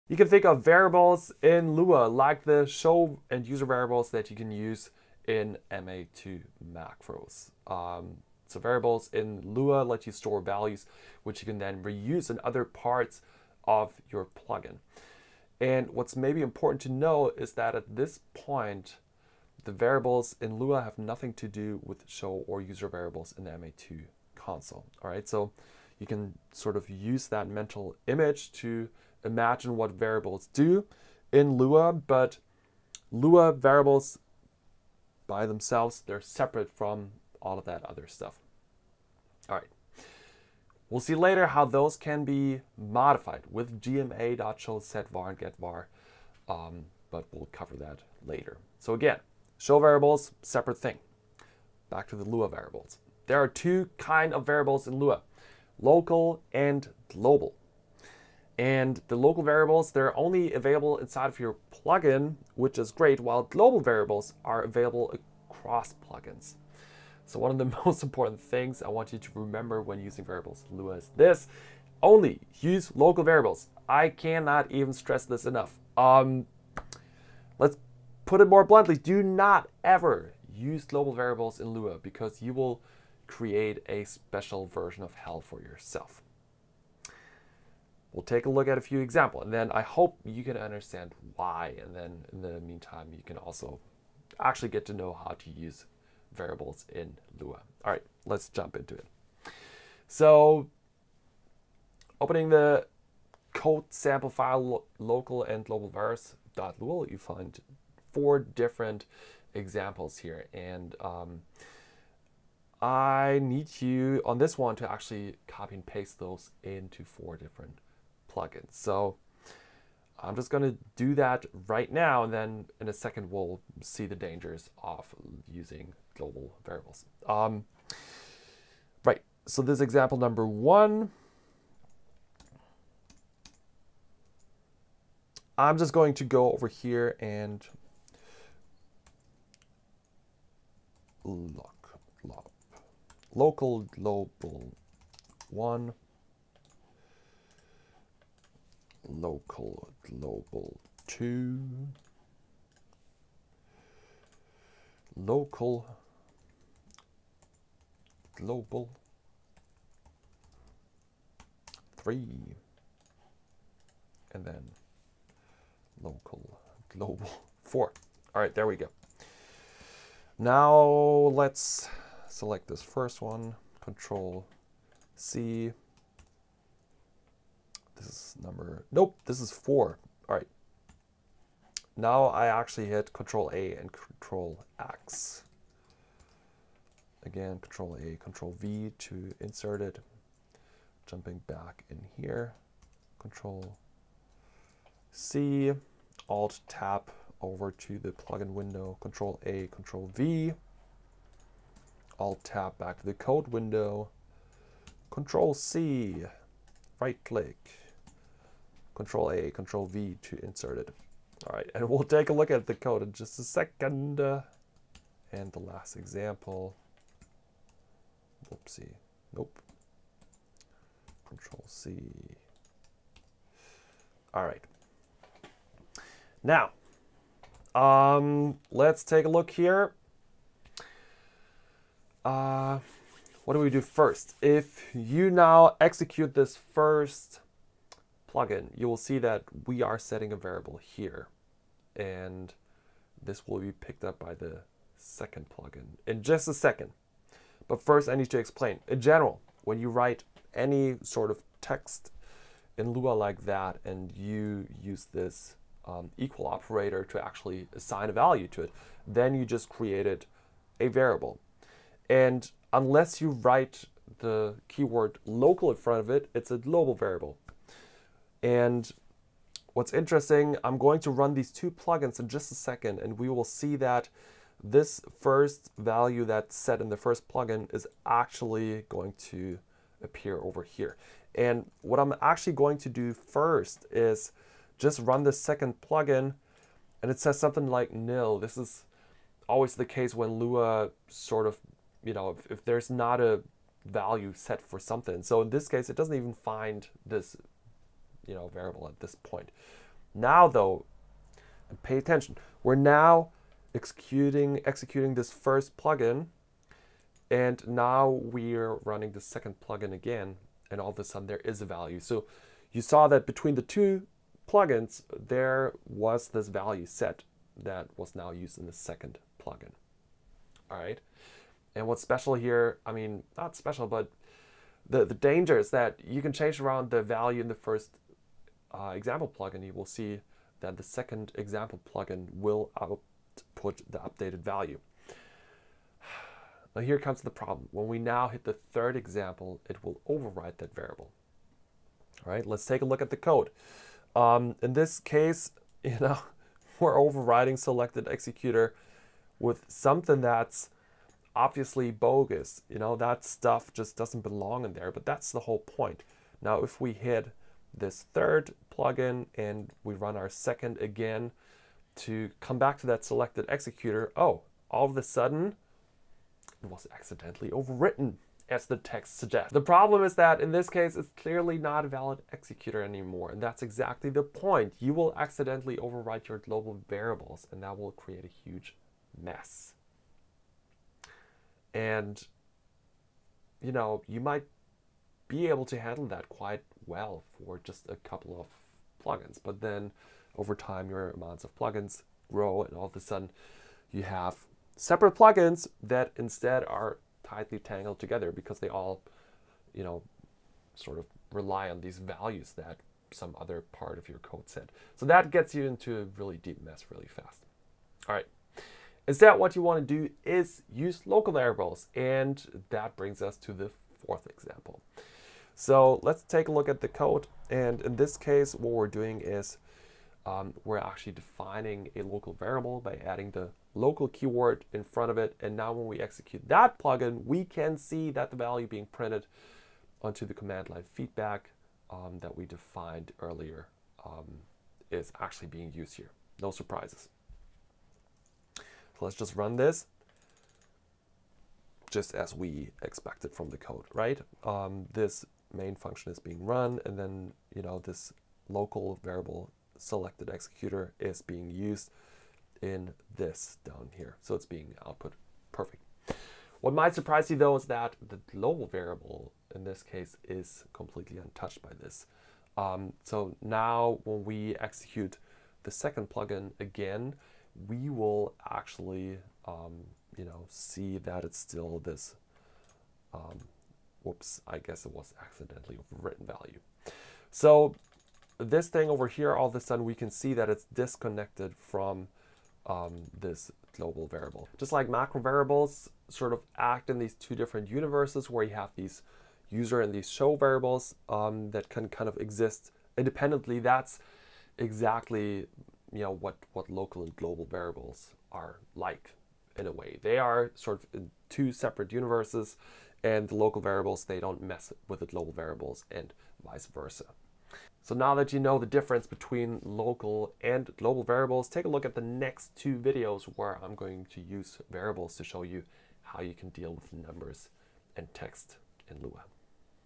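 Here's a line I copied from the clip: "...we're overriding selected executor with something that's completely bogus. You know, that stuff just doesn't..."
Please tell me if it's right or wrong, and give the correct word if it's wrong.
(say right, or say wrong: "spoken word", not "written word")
wrong: "obviously", not "completely".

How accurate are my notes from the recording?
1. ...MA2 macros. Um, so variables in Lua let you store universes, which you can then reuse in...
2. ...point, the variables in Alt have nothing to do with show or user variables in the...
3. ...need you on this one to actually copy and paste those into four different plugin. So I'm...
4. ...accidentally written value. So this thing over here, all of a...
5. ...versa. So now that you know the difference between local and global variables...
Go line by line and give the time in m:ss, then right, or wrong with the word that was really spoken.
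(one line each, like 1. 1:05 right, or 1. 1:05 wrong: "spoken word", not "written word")
1. 0:05 wrong: "values", not "universes"
2. 0:18 wrong: "Lua", not "Alt"
3. 1:53 right
4. 7:55 right
5. 8:26 right.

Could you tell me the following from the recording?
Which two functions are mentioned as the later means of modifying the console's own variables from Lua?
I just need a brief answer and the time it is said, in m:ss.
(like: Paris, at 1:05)
gma.show var and getVar, at 0:43.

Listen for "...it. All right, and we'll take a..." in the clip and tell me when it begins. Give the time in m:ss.
3:30.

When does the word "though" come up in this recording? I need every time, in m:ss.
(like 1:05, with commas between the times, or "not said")
5:00, 7:37.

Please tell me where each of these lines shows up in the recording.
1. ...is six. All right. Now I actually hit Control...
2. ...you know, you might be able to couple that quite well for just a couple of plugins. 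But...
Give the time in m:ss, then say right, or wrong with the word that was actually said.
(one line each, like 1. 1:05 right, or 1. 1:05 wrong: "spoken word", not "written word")
1. 2:59 wrong: "four", not "six"
2. 6:23 wrong: "handle", not "couple".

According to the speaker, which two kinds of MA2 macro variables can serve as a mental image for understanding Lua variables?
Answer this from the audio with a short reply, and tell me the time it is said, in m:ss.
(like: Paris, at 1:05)
show and user variables, at 0:02.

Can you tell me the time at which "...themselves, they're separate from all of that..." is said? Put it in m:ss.
0:35.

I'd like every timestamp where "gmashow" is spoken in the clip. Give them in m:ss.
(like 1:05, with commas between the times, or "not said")
0:43.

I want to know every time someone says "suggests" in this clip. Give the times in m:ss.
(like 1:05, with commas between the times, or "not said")
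6:09.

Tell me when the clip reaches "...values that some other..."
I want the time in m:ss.
6:41.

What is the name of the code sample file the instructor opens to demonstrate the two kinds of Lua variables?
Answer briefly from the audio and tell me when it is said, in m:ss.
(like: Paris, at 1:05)
local and global virus.lua, at 1:44.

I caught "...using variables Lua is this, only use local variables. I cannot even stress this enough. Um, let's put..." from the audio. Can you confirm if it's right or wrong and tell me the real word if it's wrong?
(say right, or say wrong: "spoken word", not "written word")
right.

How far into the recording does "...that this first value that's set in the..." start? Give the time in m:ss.
4:33.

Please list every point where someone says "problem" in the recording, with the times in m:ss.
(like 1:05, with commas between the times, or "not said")
5:37, 6:09.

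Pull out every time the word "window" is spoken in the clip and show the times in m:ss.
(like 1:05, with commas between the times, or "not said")
3:18, 3:23.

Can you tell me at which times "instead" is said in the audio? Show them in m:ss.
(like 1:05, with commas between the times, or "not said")
6:36, 6:49.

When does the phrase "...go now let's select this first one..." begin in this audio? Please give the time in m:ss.
2:48.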